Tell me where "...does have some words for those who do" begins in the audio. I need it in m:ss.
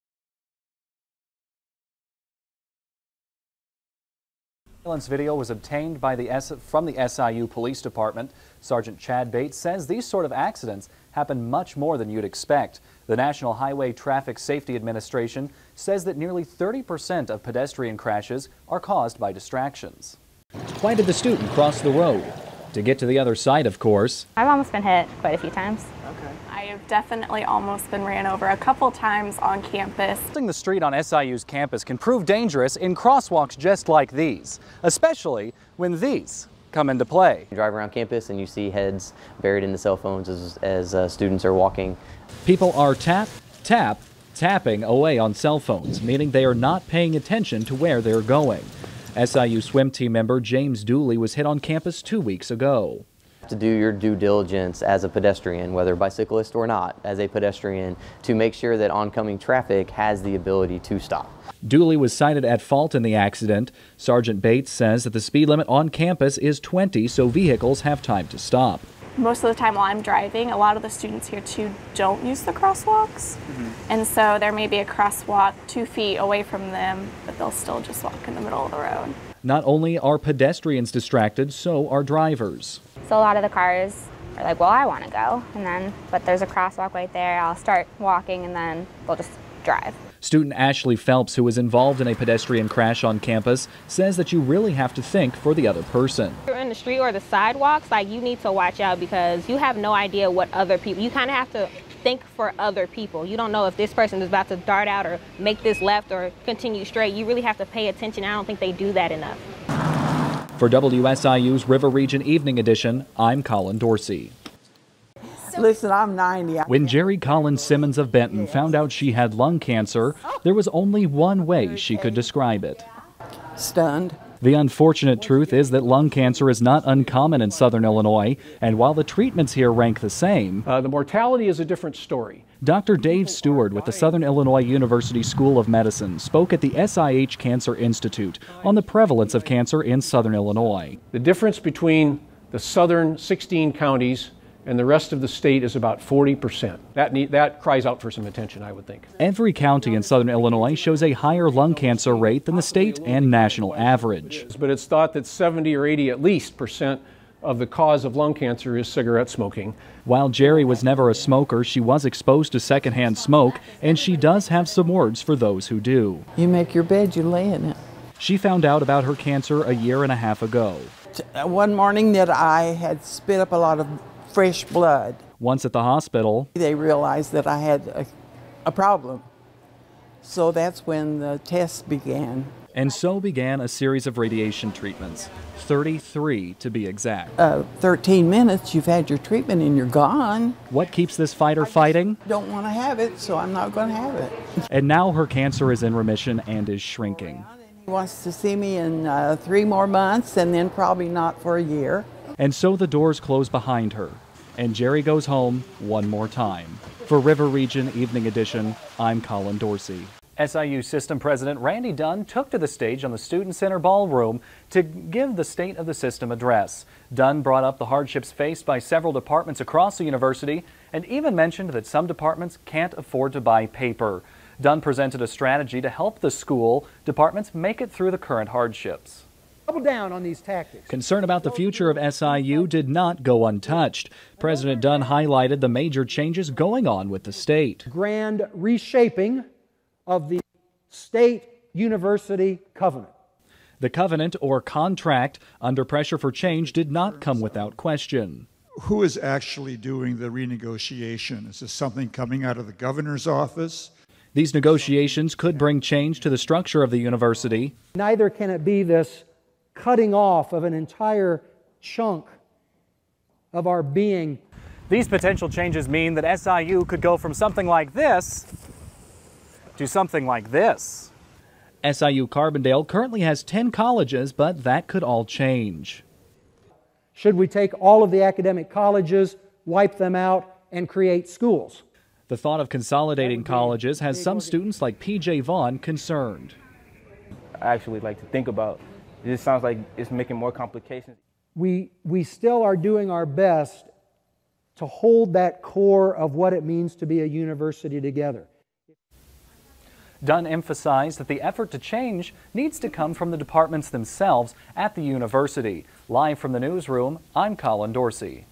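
2:44.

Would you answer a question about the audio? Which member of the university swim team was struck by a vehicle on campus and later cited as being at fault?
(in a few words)
James Dooley.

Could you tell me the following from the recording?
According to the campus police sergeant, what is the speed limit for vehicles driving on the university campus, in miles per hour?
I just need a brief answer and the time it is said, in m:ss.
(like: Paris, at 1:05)
20, at 1:06.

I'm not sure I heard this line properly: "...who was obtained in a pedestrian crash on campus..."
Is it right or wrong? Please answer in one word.
wrong.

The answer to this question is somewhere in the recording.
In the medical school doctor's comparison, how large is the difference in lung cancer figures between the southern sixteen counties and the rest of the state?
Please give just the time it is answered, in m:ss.
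2:25.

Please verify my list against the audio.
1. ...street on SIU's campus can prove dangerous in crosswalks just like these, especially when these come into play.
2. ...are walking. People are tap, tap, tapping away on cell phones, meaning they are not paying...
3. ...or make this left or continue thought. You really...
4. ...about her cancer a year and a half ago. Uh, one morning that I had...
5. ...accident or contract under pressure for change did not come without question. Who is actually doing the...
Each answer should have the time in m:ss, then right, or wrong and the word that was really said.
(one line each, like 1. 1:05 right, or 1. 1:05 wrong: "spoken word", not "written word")
1. 0:30 right
2. 0:41 right
3. 1:45 wrong: "straight", not "thought"
4. 2:48 right
5. 4:03 wrong: "covenant", not "accident".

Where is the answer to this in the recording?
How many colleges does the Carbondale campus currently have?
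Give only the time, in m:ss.
4:33.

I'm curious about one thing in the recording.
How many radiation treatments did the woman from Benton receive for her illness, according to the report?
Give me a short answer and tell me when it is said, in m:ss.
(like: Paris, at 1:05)
33, at 3:05.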